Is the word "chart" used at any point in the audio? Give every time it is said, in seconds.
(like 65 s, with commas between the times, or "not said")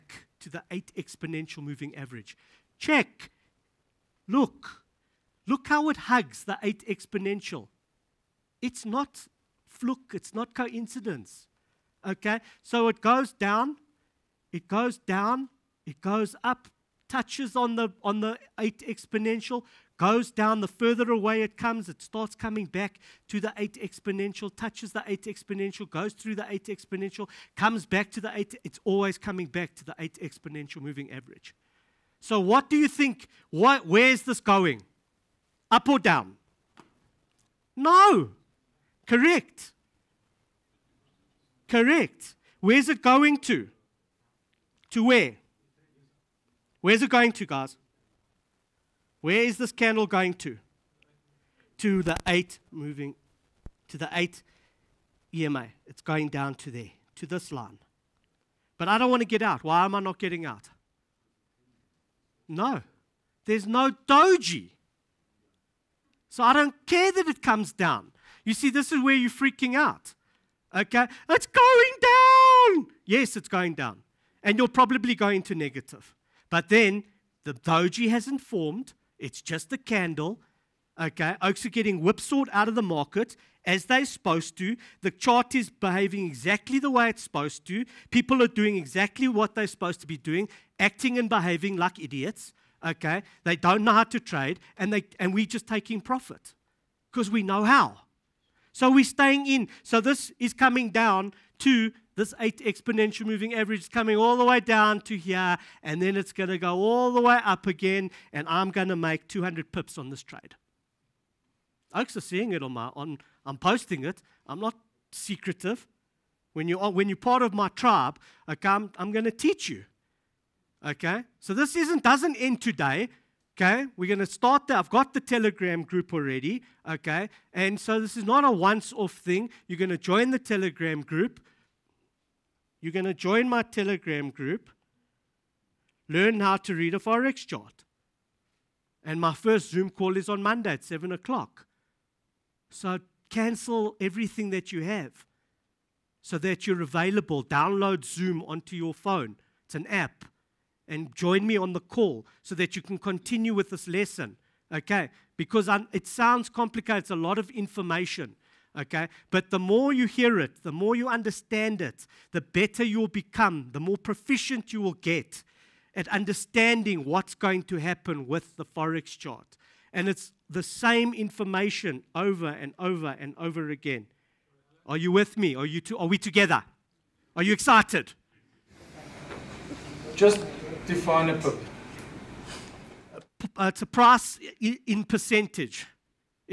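85 s, 137 s, 169 s.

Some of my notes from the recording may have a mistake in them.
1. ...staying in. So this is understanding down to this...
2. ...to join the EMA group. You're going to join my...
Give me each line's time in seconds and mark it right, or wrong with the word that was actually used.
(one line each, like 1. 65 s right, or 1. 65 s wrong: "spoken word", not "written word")
1. 99 s wrong: "coming", not "understanding"
2. 129 s wrong: "Telegram", not "EMA".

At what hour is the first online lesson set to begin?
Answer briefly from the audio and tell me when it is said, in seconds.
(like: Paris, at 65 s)
7 o'clock, at 140 s.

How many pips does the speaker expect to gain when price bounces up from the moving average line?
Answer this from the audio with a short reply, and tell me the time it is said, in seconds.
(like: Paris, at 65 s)
200, at 109 s.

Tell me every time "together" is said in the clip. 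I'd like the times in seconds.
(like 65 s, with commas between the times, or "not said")
176 s.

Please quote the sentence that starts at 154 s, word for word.
Okay, because I'm, it sounds complicated, it's a lot of information okay?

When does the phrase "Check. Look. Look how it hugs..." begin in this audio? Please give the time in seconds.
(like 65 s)
2 s.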